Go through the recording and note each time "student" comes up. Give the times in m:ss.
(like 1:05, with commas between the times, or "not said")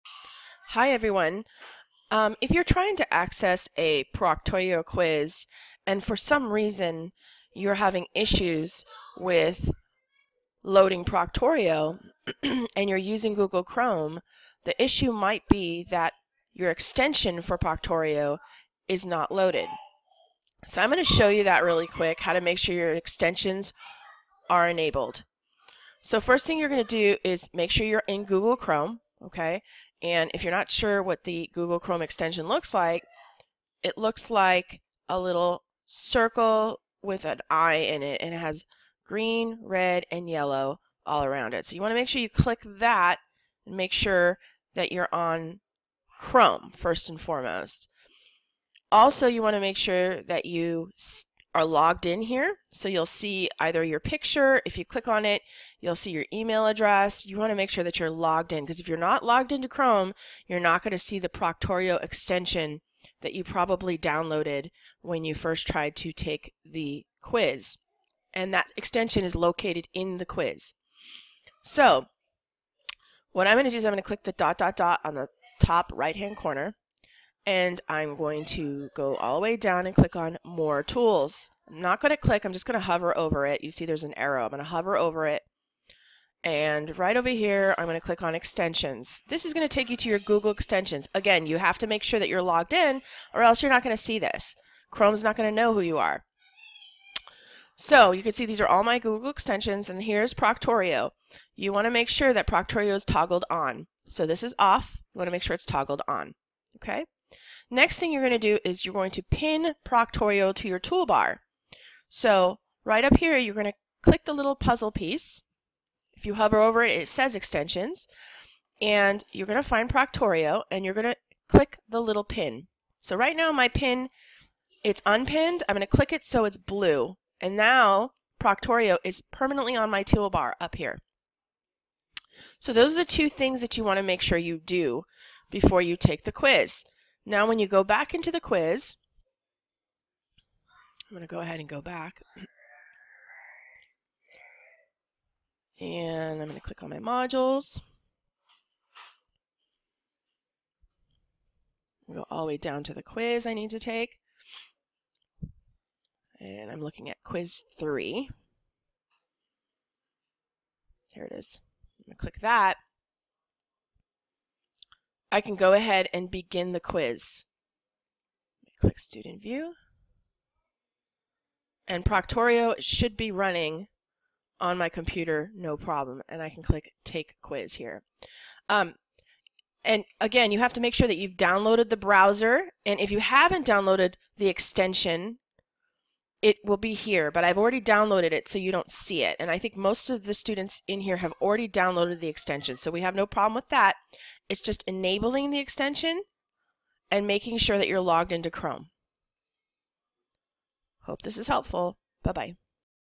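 2:48, 3:10.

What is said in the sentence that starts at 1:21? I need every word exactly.
I'm not going to click, I'm just going to hover over it.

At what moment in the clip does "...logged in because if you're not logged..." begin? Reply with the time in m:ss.
0:58.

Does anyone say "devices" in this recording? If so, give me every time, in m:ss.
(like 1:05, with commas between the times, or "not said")
not said.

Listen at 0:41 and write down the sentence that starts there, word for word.
So you want to make sure you click that and make sure that you're on Chrome first and foremost.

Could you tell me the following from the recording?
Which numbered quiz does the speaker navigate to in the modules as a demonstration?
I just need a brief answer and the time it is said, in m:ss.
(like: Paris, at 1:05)
Quiz 3, at 2:37.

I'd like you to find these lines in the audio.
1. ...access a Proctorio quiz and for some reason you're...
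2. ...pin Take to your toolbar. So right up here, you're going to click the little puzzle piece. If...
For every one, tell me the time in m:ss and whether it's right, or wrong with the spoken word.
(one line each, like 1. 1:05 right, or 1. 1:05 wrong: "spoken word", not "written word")
1. 0:03 right
2. 1:49 wrong: "Proctorio", not "Take".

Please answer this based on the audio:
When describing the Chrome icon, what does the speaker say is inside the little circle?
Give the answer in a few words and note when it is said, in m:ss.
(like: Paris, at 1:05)
an eye, at 0:37.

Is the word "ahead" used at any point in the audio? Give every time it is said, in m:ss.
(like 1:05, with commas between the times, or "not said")
2:21, 2:45.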